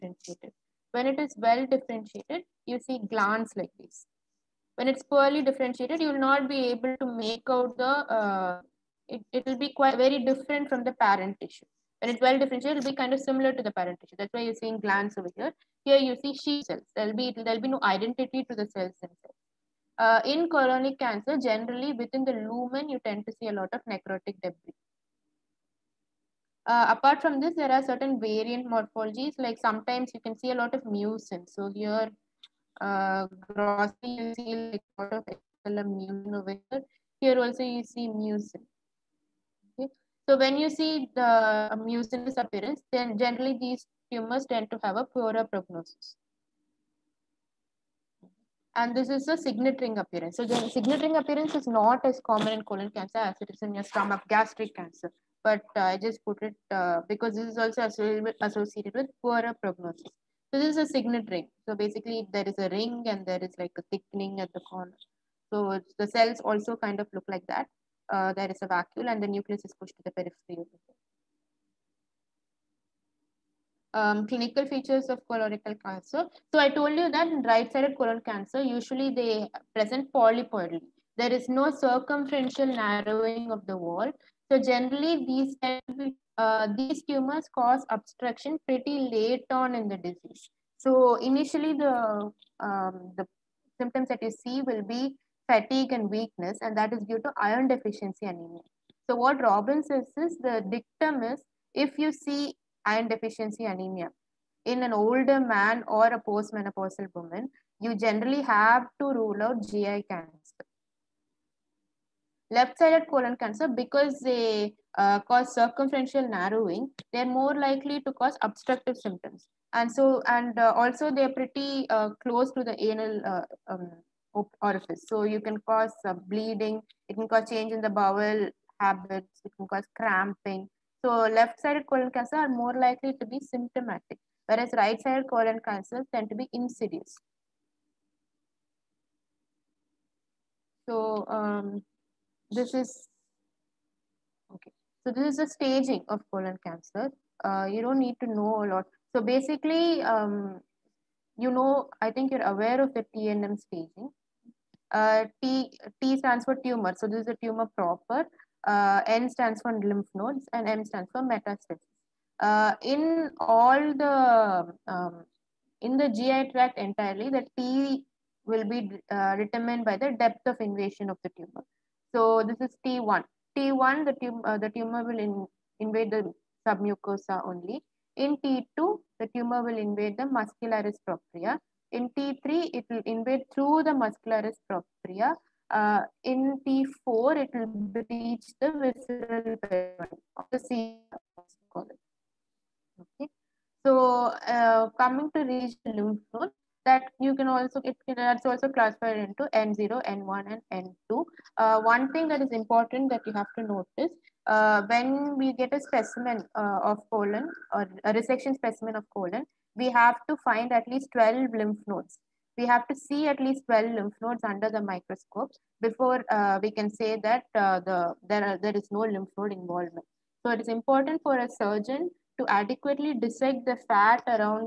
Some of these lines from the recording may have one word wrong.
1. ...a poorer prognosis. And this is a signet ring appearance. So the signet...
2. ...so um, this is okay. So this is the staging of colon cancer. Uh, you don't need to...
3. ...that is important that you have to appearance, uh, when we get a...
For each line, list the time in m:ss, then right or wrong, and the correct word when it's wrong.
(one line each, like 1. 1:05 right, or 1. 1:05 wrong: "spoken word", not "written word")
1. 0:44 right
2. 2:20 right
3. 3:22 wrong: "notice", not "appearance".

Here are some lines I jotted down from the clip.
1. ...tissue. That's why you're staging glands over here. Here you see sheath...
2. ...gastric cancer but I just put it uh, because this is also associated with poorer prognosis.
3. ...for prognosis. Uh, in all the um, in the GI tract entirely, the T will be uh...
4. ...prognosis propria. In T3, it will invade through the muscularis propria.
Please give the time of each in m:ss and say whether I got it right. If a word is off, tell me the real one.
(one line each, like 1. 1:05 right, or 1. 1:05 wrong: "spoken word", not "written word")
1. 0:14 wrong: "seeing", not "staging"
2. 0:54 right
3. 2:41 wrong: "metastasis", not "prognosis"
4. 3:00 wrong: "muscularis", not "prognosis".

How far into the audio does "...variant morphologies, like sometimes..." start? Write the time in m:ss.
0:28.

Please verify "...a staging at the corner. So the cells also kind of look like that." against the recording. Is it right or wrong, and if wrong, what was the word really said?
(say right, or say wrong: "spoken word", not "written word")
wrong: "thickening", not "staging".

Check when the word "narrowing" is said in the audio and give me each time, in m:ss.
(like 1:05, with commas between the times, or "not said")
1:22, 1:56.